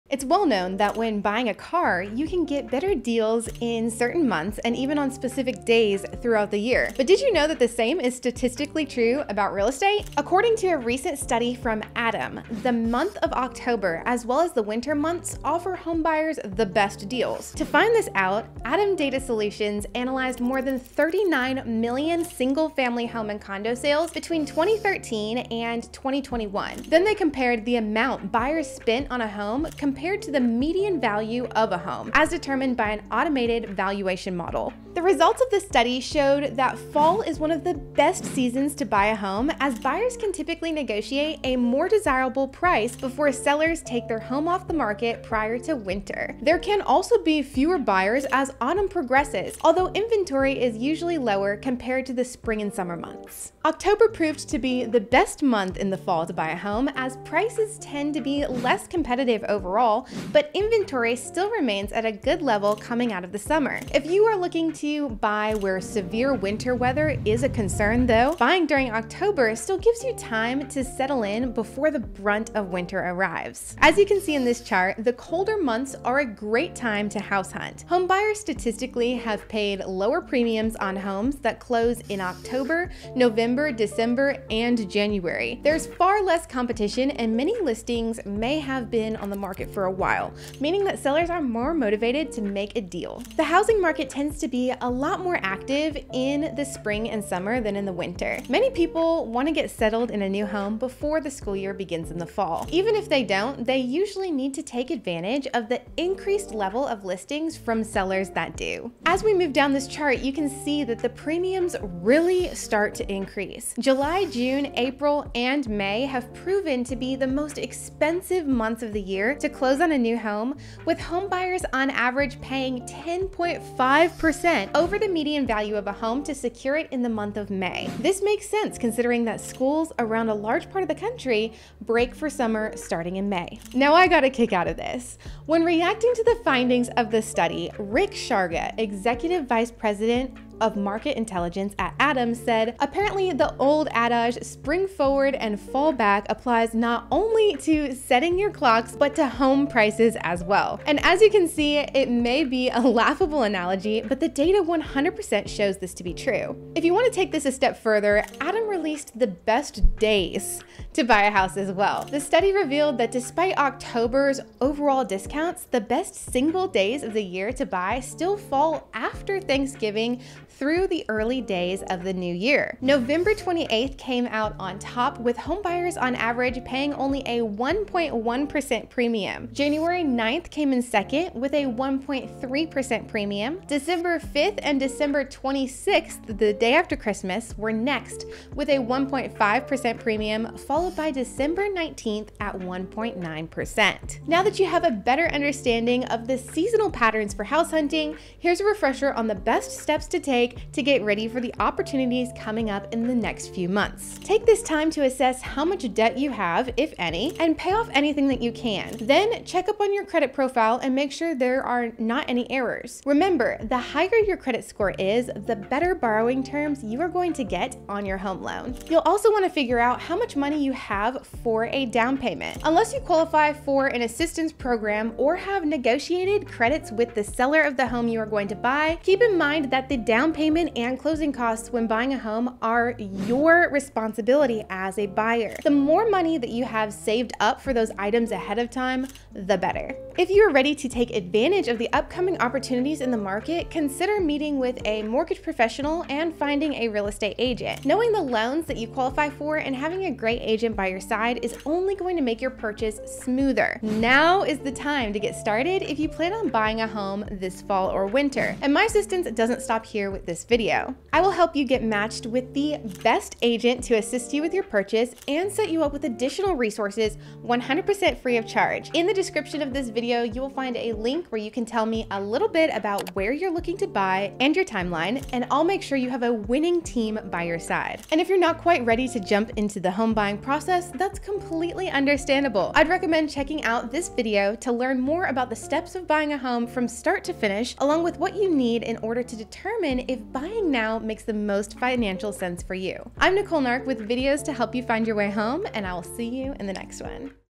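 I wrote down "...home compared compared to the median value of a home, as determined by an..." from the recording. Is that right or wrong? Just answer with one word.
right.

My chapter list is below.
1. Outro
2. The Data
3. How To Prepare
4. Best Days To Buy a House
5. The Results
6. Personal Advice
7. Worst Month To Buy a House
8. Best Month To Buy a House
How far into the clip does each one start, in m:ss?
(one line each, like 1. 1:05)
1. 4:38
2. 0:16
3. 3:18
4. 2:40
5. 0:35
6. 4:00
7. 1:33
8. 0:54.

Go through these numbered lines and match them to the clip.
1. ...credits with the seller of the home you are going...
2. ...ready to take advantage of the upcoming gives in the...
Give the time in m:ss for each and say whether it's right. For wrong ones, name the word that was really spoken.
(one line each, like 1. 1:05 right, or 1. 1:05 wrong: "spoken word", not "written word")
1. 3:46 right
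2. 4:00 wrong: "opportunities", not "gives".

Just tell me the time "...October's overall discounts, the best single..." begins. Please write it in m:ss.
2:43.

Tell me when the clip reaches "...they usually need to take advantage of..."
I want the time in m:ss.
1:43.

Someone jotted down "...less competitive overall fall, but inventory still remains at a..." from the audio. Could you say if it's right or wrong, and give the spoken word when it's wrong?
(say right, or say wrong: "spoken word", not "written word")
right.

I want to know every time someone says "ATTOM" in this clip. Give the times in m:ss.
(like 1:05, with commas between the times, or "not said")
0:11, 0:18, 2:21, 2:38.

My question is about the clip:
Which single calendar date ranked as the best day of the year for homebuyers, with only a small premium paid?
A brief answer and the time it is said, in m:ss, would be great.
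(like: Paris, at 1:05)
November 28, at 2:52.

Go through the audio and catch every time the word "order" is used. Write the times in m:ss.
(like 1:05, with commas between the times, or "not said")
4:48.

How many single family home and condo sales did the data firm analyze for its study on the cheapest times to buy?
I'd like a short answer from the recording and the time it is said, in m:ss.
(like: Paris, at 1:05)
39 million, at 0:20.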